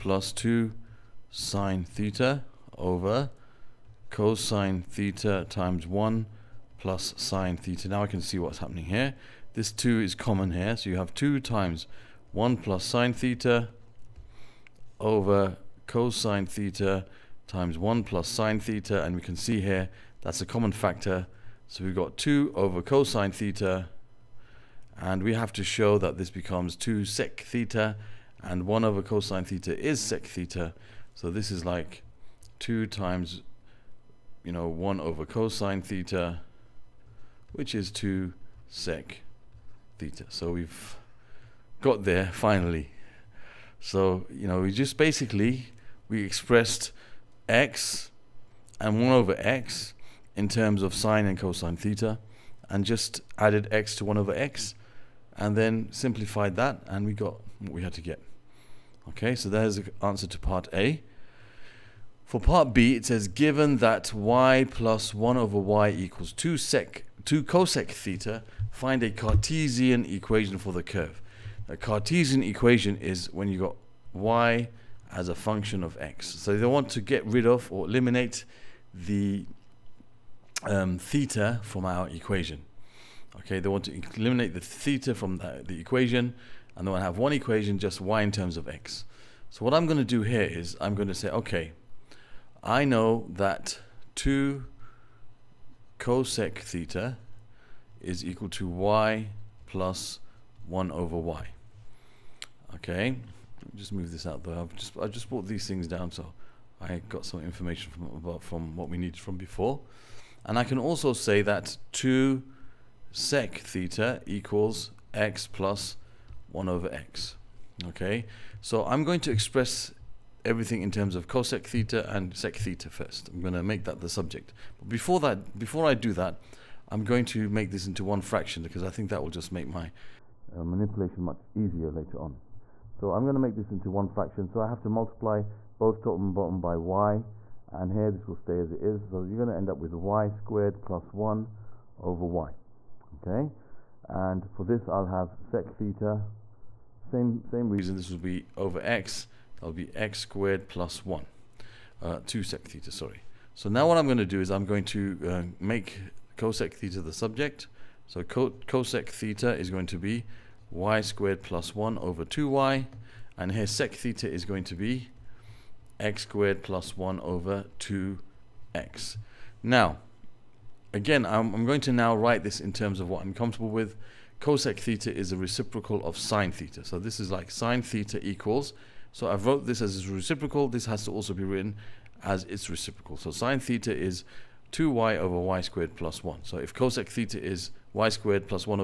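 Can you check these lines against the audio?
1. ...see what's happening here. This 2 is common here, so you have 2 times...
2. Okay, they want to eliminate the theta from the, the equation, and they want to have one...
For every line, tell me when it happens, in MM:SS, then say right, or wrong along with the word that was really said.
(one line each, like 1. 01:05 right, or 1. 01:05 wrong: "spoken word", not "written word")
1. 00:08 right
2. 01:23 right.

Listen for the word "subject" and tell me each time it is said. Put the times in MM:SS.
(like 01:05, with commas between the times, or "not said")
02:04, 02:37.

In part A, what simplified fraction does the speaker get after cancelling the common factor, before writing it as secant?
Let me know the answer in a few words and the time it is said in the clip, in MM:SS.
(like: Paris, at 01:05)
2 over cosine theta, at 00:22.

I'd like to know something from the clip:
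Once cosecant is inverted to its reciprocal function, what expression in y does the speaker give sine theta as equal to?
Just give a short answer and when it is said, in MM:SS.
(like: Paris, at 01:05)
2y over y squared plus 1, at 03:04.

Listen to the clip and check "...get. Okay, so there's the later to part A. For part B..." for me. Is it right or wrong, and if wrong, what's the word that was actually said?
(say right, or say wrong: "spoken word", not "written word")
wrong: "answer", not "later".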